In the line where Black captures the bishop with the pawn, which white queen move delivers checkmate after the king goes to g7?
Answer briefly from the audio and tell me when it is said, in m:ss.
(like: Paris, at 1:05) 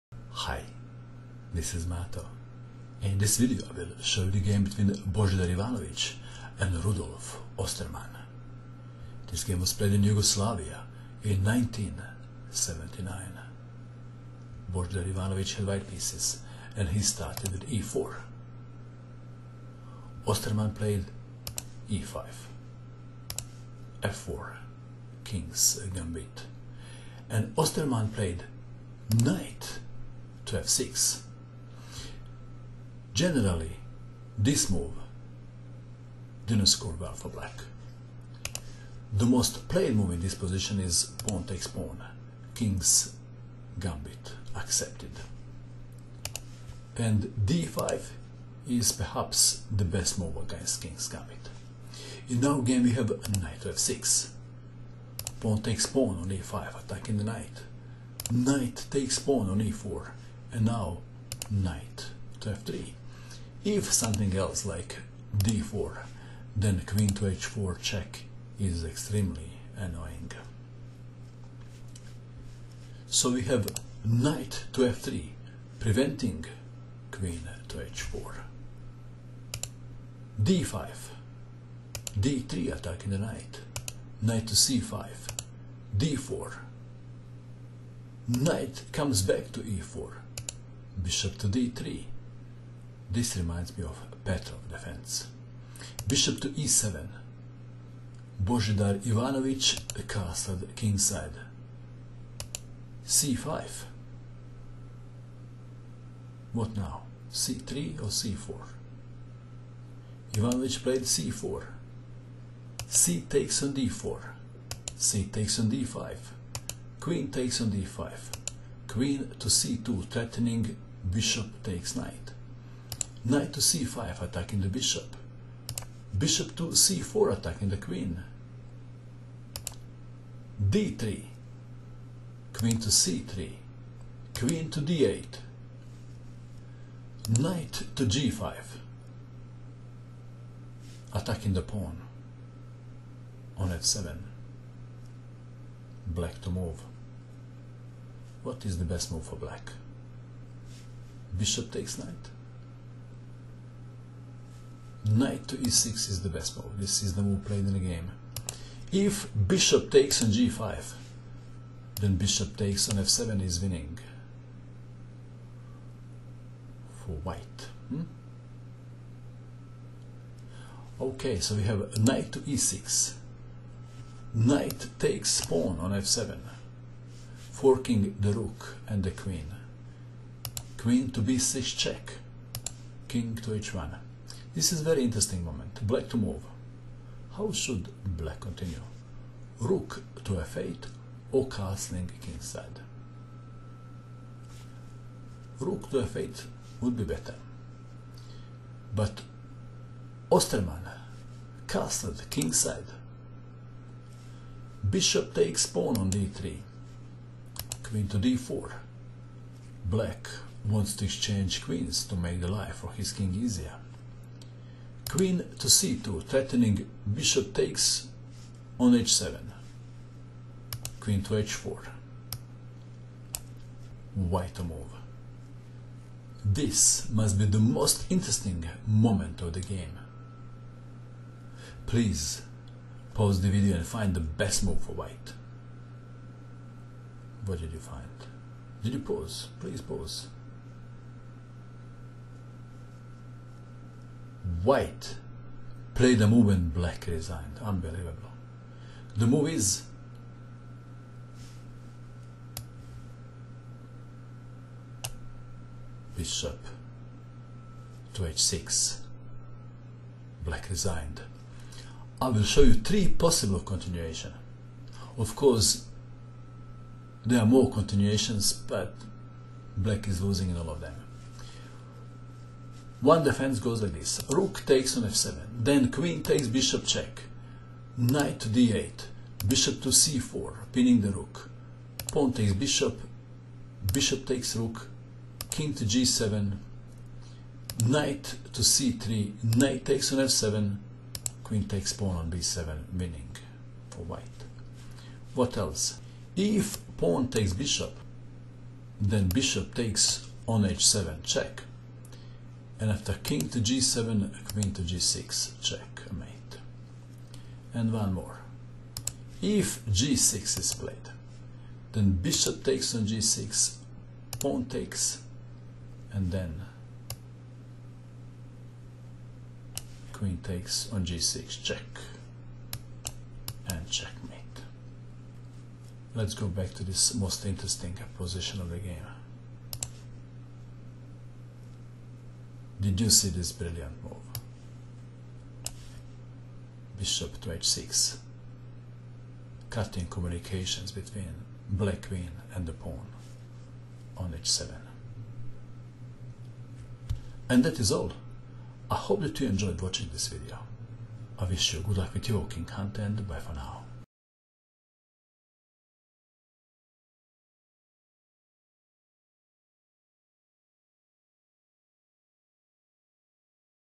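Queen to g6, at 5:04.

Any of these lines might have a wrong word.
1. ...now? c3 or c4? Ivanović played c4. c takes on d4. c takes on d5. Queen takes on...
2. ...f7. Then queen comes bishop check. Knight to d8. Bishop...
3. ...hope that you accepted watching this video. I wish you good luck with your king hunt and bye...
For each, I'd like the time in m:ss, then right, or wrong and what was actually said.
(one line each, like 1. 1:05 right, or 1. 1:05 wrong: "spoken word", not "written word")
1. 1:46 right
2. 4:35 wrong: "takes", not "comes"
3. 5:48 wrong: "enjoyed", not "accepted".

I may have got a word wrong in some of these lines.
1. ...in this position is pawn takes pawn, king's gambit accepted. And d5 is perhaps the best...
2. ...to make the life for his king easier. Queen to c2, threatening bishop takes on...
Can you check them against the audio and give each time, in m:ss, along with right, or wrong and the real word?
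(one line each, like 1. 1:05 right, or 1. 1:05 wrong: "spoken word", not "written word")
1. 0:40 right
2. 3:32 right.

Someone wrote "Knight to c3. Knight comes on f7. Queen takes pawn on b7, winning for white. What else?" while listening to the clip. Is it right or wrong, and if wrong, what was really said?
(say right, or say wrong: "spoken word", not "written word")
wrong: "takes", not "comes".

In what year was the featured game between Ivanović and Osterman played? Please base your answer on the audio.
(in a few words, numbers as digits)
1979.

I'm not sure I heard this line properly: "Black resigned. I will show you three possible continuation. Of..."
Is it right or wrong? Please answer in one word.
right.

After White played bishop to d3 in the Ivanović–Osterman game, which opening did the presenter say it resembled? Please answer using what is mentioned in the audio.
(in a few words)
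Petrov defense.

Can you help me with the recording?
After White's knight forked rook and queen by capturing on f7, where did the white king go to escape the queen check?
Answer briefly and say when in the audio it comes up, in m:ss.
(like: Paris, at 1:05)
h1, at 3:03.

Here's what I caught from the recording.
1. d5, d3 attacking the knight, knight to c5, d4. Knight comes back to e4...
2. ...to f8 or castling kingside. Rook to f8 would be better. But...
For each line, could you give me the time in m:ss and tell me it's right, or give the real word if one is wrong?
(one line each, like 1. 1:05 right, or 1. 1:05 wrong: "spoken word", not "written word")
1. 1:20 right
2. 3:10 right.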